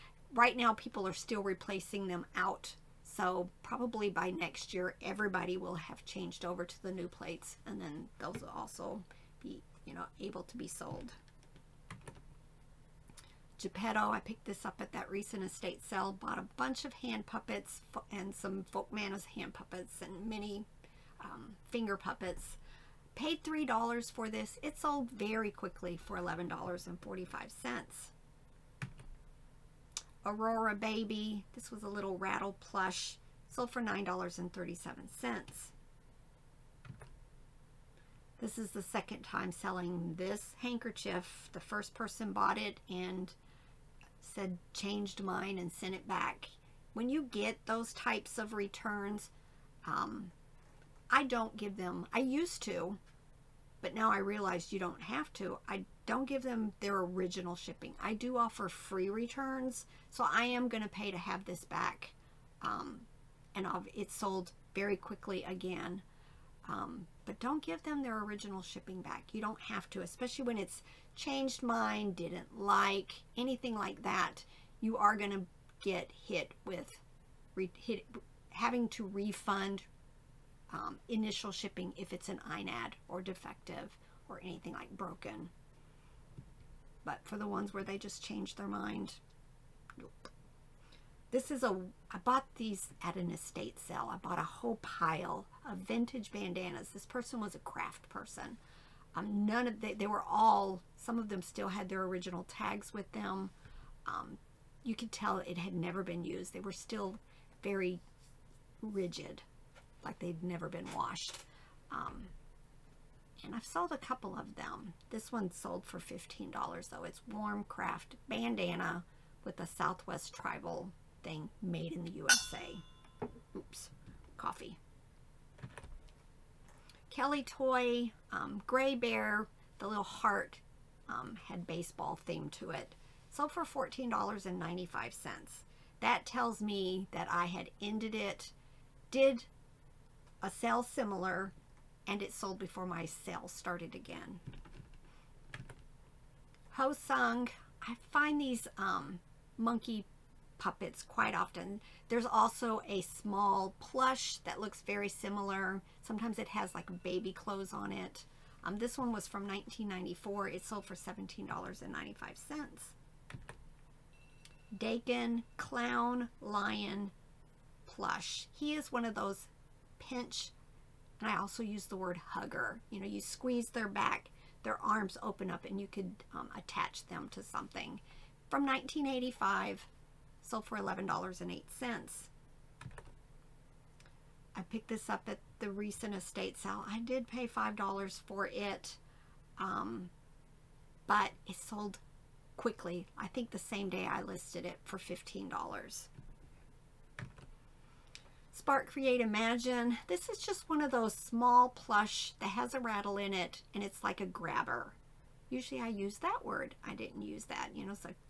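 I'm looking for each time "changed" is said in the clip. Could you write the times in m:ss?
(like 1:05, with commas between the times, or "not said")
0:06, 0:44, 1:11, 1:28.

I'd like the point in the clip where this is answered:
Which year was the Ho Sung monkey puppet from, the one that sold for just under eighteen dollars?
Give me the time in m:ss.
2:39.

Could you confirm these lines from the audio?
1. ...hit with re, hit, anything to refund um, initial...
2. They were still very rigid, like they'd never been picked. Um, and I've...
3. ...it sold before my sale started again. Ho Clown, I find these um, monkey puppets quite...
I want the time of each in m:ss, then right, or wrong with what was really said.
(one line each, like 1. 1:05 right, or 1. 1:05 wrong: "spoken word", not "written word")
1. 1:16 wrong: "having", not "anything"
2. 1:46 wrong: "washed", not "picked"
3. 2:22 wrong: "Sung", not "Clown".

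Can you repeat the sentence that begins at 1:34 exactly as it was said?
I bought a whole pile of vintage bandanas.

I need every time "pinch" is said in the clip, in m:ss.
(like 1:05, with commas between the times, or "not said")
2:49.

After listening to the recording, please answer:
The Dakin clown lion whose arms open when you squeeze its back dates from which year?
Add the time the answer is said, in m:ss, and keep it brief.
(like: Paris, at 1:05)
1985, at 2:58.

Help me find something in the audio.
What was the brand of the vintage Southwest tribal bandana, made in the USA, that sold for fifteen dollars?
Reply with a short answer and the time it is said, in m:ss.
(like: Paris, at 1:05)
Wamcraft, at 1:57.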